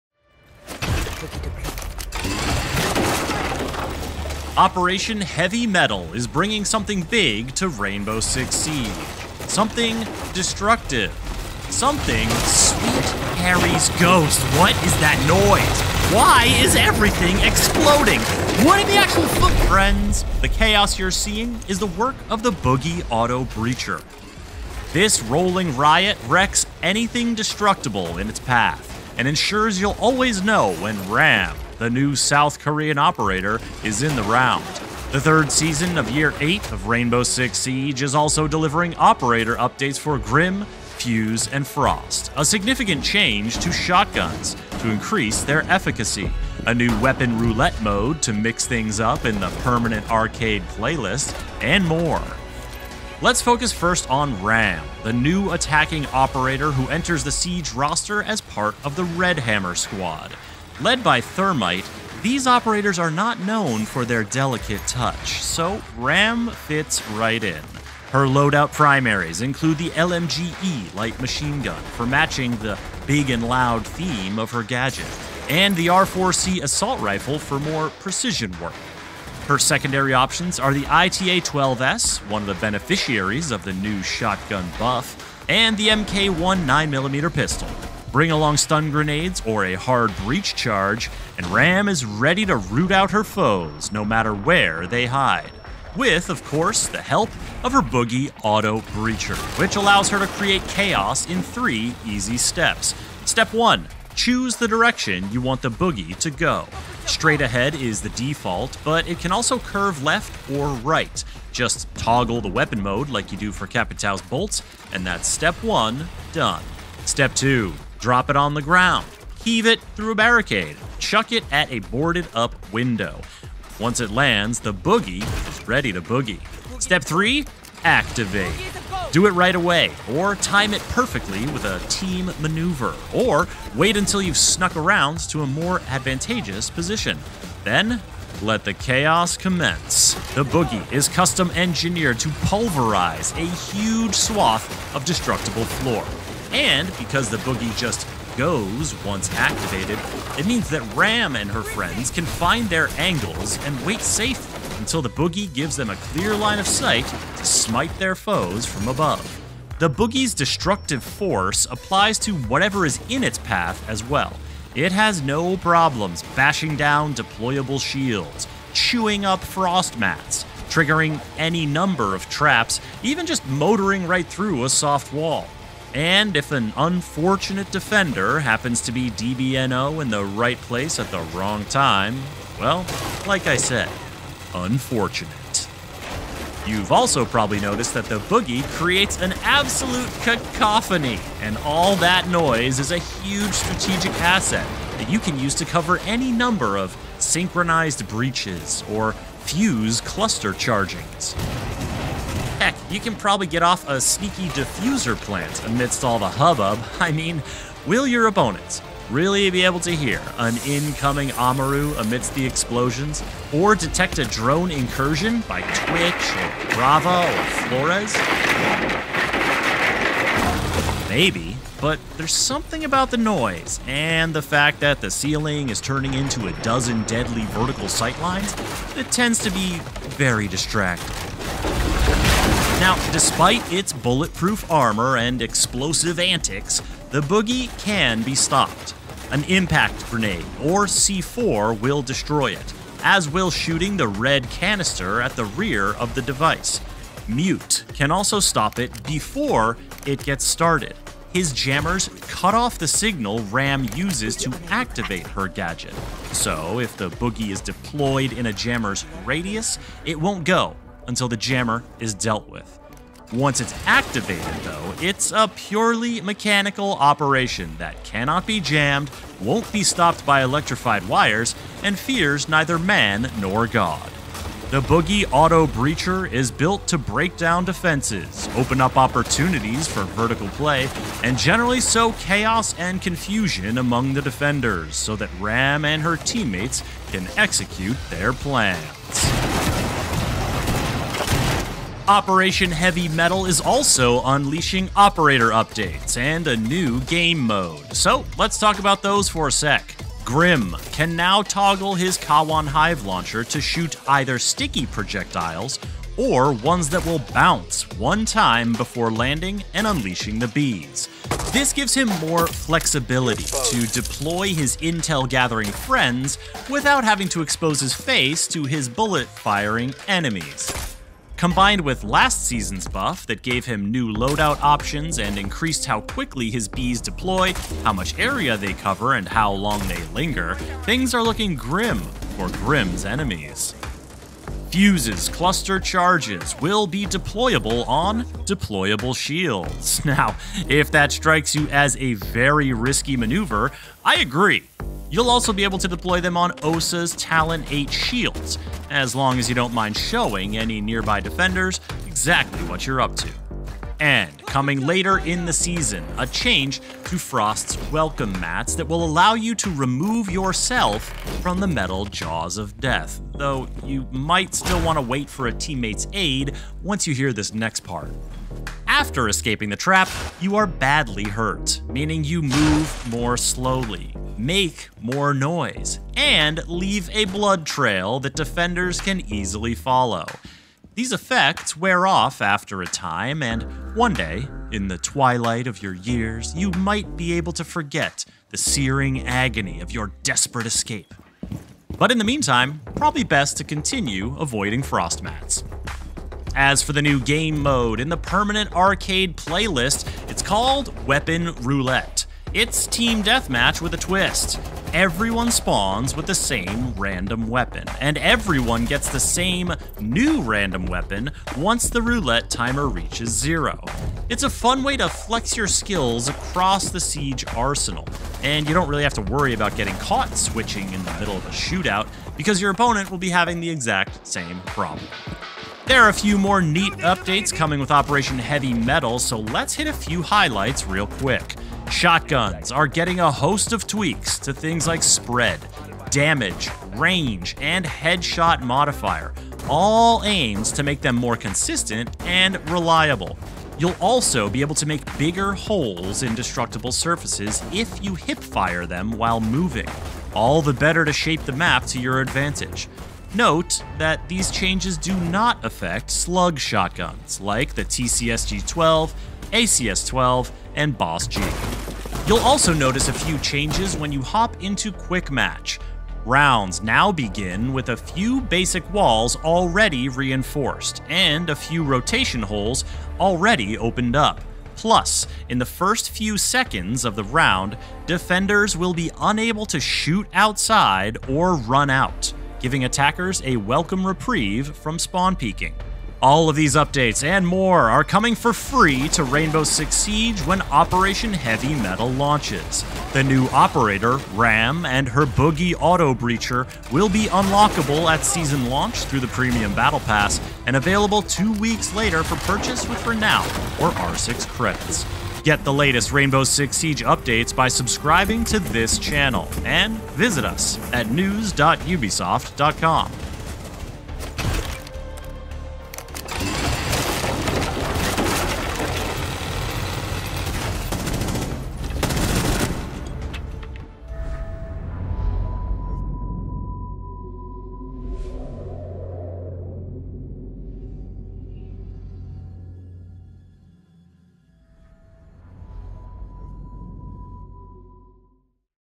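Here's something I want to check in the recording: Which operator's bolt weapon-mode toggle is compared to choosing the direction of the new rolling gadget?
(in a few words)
Capitao.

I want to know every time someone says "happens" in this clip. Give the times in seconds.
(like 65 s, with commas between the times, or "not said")
178 s.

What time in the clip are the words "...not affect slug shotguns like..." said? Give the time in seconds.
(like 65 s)
455 s.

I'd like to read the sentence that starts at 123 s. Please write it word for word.
Once it lands, the BU-GI is ready to boogie.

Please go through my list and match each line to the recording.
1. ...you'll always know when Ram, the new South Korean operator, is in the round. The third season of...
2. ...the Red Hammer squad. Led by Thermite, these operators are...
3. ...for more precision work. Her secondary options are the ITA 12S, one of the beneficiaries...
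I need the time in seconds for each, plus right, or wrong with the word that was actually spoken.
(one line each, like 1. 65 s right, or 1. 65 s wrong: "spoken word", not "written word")
1. 29 s right
2. 58 s right
3. 77 s right.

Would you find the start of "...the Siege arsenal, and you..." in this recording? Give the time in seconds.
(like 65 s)
416 s.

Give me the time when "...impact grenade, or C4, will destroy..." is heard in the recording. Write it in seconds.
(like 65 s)
239 s.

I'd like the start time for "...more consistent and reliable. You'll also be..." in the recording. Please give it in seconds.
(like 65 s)
441 s.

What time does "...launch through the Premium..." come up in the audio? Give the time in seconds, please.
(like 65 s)
498 s.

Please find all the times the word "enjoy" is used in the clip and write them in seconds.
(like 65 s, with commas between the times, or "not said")
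not said.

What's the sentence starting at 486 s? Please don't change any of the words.
All of these updates and more are coming for free to Rainbow Six Siege when Operation Heavy Mettle launches.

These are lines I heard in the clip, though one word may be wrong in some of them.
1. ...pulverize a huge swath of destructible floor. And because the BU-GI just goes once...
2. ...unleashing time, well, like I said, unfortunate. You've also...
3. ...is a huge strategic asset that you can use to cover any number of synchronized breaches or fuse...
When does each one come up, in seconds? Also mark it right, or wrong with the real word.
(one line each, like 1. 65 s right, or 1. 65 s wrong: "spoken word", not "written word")
1. 142 s right
2. 181 s wrong: "wrong", not "unleashing"
3. 192 s right.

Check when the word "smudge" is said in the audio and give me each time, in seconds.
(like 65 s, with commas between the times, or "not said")
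not said.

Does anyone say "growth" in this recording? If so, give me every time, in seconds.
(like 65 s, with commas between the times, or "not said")
not said.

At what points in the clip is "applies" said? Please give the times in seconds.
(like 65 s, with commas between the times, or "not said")
161 s.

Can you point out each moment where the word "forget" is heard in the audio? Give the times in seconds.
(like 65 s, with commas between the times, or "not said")
387 s.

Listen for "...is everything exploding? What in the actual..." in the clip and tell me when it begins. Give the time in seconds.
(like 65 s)
16 s.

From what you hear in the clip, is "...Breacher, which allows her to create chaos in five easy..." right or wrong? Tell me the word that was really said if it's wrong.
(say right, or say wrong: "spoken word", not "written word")
wrong: "three", not "five".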